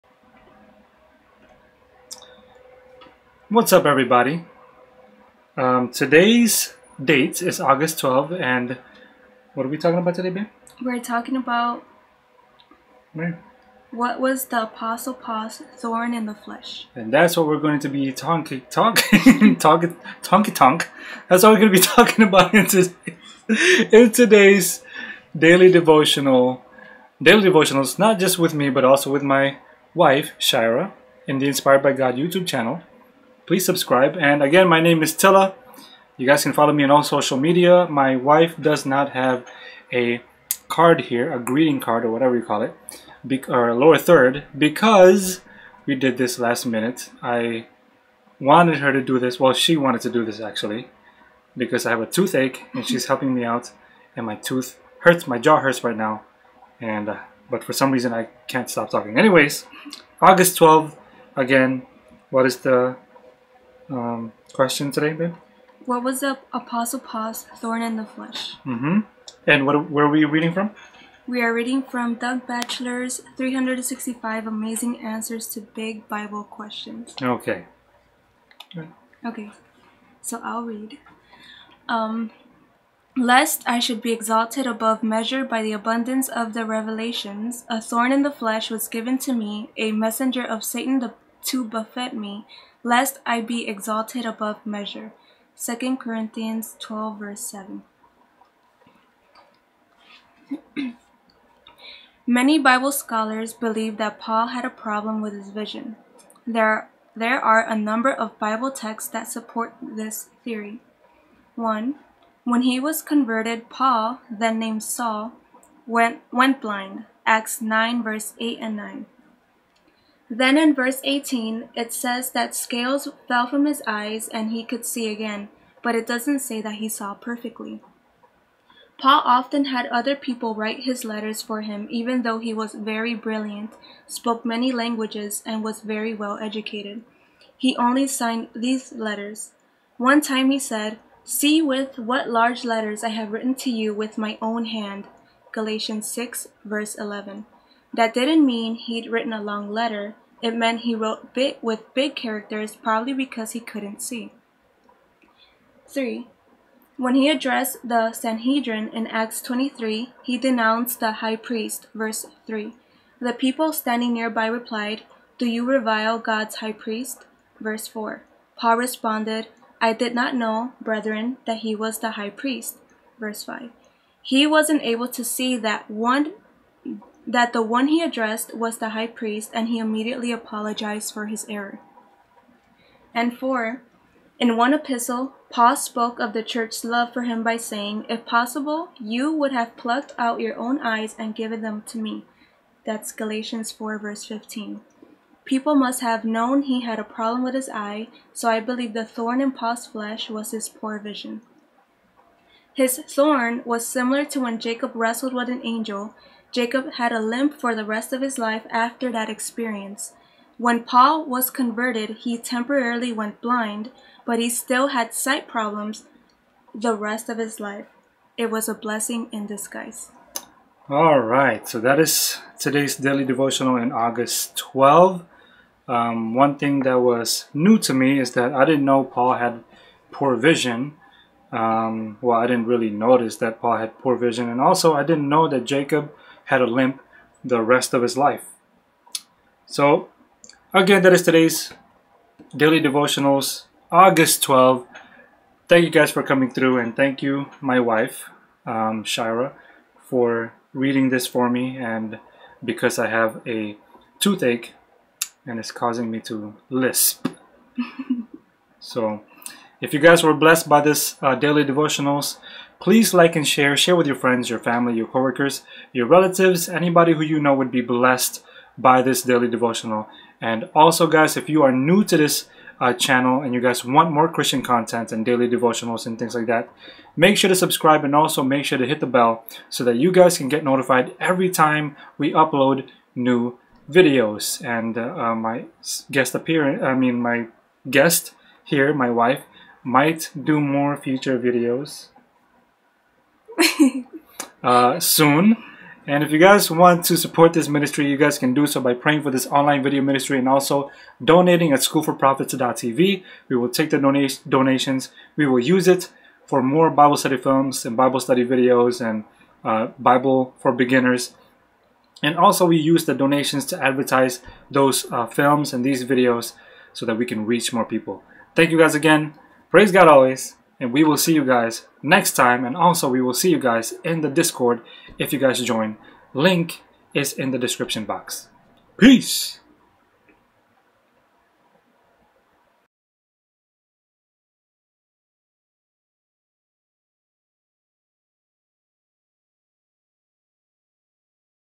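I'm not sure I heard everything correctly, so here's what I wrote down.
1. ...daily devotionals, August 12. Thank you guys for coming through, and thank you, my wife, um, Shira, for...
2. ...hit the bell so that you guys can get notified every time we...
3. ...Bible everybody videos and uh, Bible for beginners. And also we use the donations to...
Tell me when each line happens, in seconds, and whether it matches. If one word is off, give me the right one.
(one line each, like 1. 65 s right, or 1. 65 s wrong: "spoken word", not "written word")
1. 242 s right
2. 278 s right
3. 307 s wrong: "study", not "everybody".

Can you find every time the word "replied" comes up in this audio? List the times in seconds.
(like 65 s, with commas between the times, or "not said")
164 s.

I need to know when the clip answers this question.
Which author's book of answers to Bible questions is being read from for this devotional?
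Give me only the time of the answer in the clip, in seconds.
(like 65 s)
72 s.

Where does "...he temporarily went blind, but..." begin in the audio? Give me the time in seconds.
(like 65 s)
212 s.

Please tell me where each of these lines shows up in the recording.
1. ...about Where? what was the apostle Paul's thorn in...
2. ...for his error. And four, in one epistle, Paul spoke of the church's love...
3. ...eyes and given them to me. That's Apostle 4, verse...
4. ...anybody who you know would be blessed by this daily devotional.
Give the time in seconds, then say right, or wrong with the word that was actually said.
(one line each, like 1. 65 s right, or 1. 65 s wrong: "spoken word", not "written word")
1. 11 s right
2. 181 s right
3. 190 s wrong: "Galatians", not "Apostle"
4. 266 s right.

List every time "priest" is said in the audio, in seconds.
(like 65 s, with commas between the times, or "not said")
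161 s, 166 s, 172 s, 179 s.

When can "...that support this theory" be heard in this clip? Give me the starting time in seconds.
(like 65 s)
109 s.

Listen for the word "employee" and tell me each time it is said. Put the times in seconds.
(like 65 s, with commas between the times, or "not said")
not said.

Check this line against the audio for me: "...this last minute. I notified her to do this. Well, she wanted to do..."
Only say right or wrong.
wrong.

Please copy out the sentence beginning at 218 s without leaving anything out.
It was a blessing in disguise.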